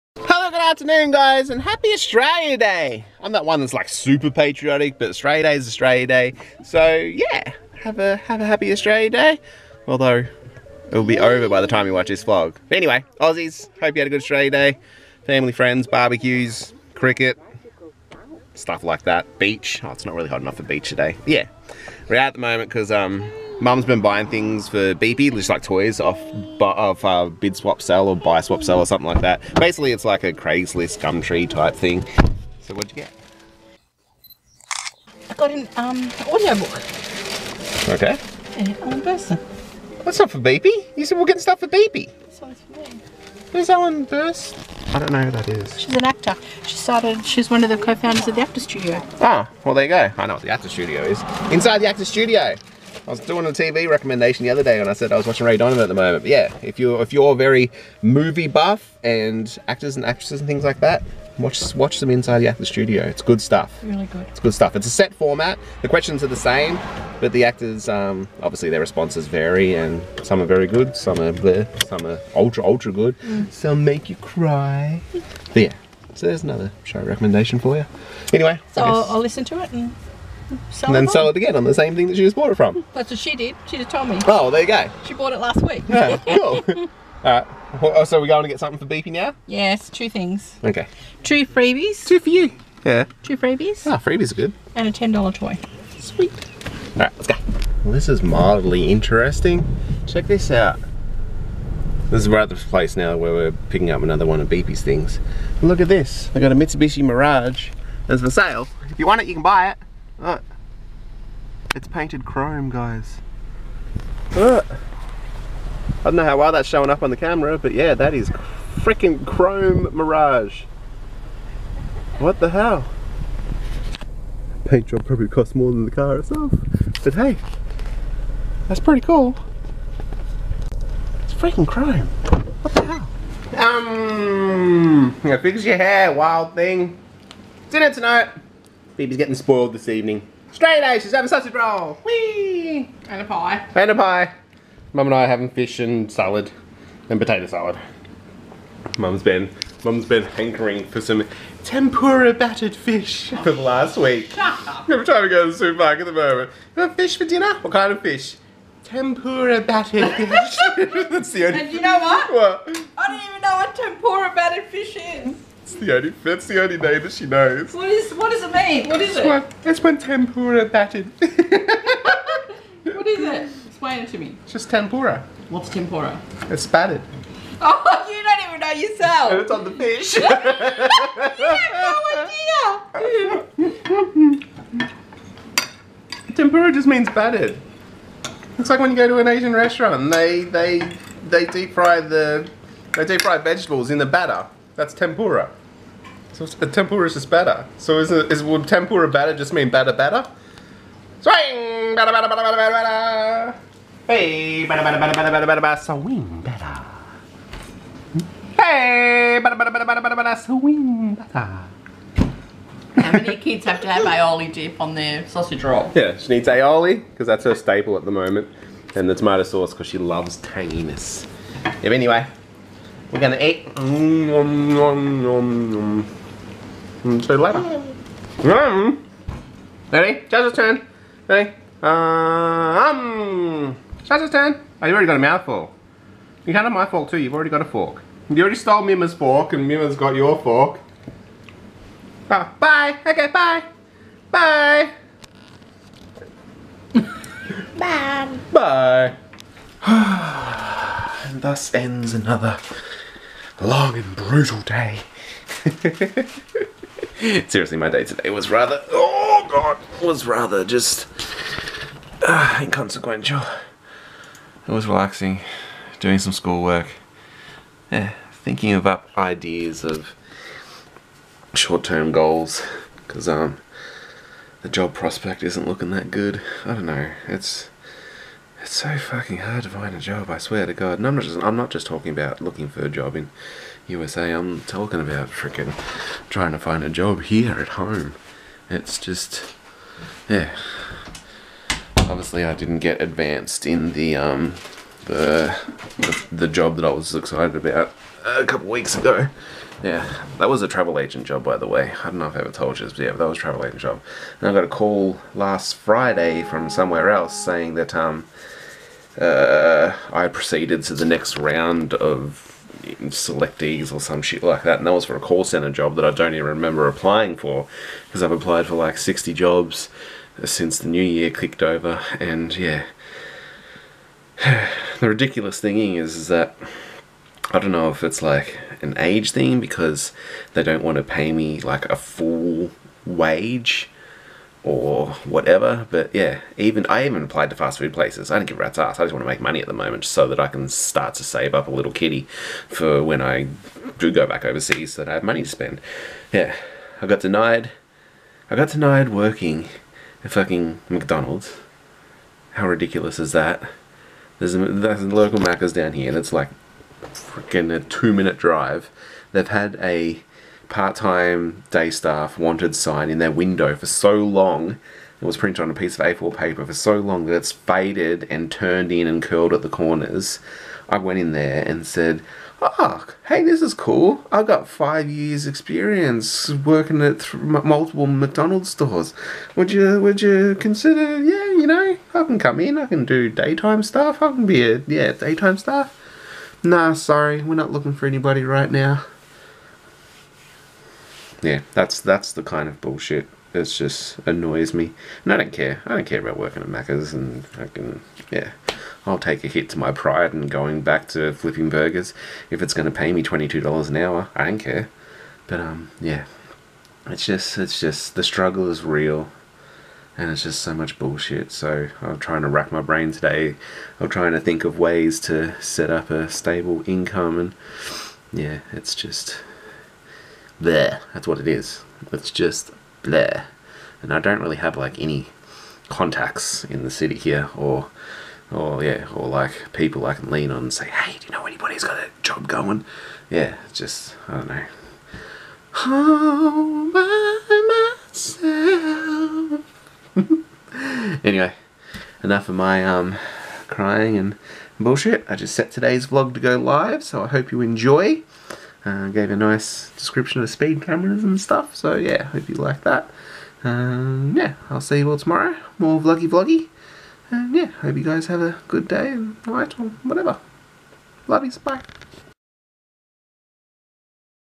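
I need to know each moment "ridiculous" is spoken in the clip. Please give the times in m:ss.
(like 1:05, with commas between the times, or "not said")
5:25, 5:52.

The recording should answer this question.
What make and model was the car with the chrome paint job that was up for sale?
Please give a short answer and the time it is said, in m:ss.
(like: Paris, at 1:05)
Mitsubishi Mirage, at 1:46.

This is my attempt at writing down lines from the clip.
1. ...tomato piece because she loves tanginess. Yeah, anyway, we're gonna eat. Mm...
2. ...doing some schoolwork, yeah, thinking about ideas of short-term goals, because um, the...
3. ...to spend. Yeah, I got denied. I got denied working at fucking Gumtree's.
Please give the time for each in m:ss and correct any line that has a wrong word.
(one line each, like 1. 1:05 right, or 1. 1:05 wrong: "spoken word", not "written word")
1. 3:39 wrong: "sauce", not "piece"
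2. 4:25 right
3. 5:45 wrong: "McDonald", not "Gumtree".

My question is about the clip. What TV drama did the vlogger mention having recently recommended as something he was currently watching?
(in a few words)
Ray Donovan.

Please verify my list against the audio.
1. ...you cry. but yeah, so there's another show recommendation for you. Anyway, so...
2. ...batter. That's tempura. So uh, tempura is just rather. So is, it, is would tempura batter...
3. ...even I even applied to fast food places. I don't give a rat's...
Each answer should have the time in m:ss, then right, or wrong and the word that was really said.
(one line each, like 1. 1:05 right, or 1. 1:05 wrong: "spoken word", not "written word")
1. 1:14 right
2. 3:14 wrong: "batter", not "rather"
3. 5:36 right.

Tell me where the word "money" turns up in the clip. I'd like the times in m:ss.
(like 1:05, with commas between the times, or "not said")
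5:39, 5:45.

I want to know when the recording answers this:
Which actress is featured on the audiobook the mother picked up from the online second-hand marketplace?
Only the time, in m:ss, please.
0:38.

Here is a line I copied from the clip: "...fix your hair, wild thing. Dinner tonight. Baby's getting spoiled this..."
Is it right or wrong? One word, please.
right.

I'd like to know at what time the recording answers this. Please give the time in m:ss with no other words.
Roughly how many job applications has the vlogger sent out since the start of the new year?
5:18.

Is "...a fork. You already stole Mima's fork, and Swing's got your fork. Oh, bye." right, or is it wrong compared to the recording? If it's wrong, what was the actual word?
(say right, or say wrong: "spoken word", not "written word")
wrong: "Mima", not "Swing".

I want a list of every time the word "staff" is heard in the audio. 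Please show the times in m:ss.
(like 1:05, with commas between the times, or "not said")
6:01, 6:25.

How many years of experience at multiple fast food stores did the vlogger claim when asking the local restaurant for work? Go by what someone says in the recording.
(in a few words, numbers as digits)
5.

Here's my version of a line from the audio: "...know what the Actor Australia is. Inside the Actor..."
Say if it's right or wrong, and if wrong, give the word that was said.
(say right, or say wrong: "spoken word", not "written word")
wrong: "Studio", not "Australia".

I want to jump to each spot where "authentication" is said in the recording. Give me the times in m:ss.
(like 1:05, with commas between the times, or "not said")
not said.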